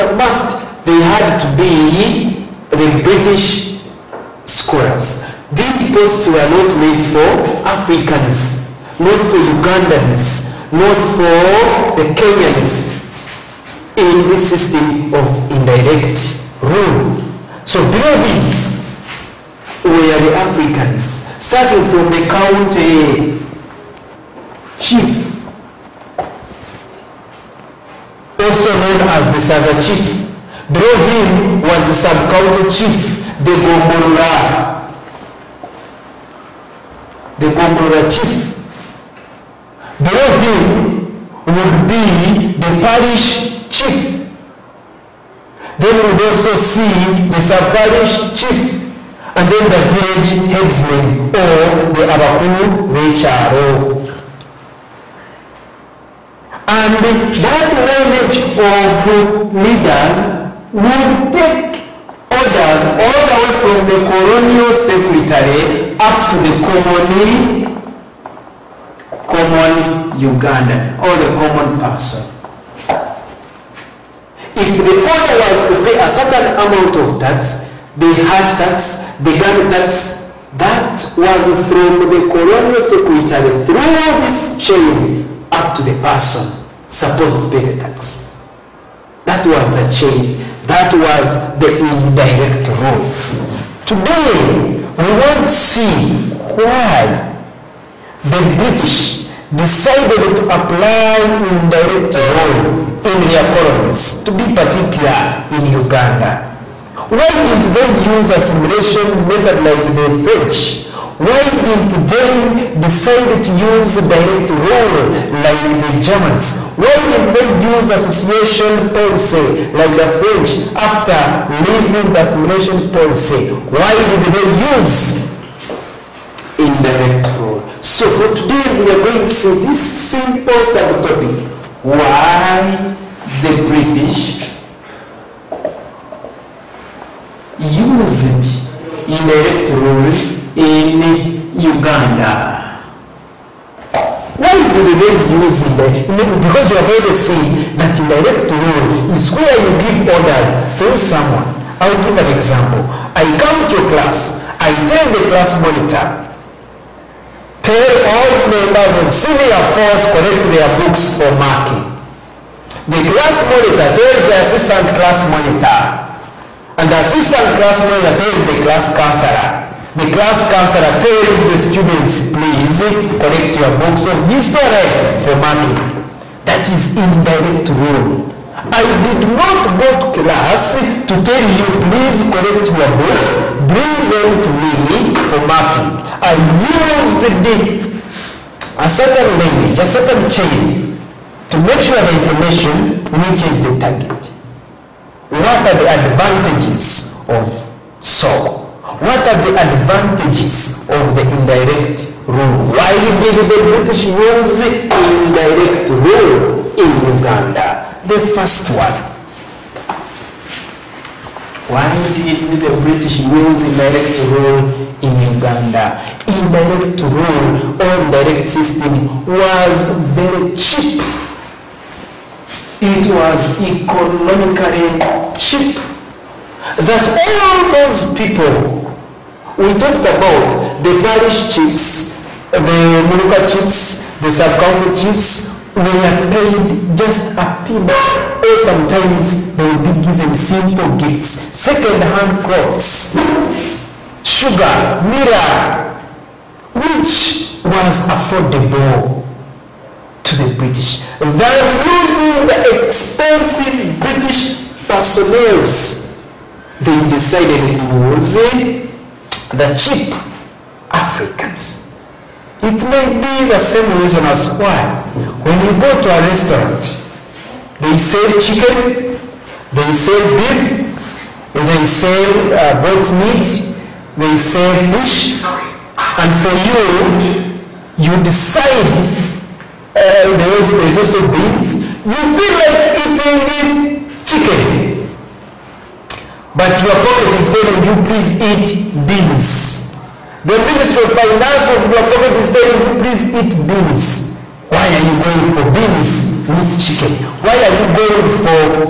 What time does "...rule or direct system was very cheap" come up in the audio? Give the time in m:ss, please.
3:37.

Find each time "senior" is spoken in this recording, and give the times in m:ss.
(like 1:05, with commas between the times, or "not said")
2:39.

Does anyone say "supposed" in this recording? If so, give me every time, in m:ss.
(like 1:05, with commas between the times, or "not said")
1:26.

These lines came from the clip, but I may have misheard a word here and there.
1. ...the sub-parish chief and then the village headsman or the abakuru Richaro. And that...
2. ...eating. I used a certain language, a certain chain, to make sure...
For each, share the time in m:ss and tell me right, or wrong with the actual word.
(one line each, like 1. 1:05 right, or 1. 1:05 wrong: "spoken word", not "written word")
1. 0:47 right
2. 3:05 wrong: "marking", not "eating".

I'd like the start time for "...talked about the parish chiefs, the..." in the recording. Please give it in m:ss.
3:49.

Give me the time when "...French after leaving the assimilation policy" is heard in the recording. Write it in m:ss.
2:00.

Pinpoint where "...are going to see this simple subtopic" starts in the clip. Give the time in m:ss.
2:08.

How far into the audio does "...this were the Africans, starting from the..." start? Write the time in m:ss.
0:18.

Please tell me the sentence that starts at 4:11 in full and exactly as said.
They are using the expensive British personnel.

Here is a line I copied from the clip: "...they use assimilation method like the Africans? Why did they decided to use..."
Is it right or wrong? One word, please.
wrong.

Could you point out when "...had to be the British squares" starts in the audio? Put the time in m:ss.
0:01.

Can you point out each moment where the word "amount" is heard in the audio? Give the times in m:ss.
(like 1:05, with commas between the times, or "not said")
1:16.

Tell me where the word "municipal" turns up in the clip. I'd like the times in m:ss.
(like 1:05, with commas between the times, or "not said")
3:52.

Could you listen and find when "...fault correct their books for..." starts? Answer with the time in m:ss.
2:39.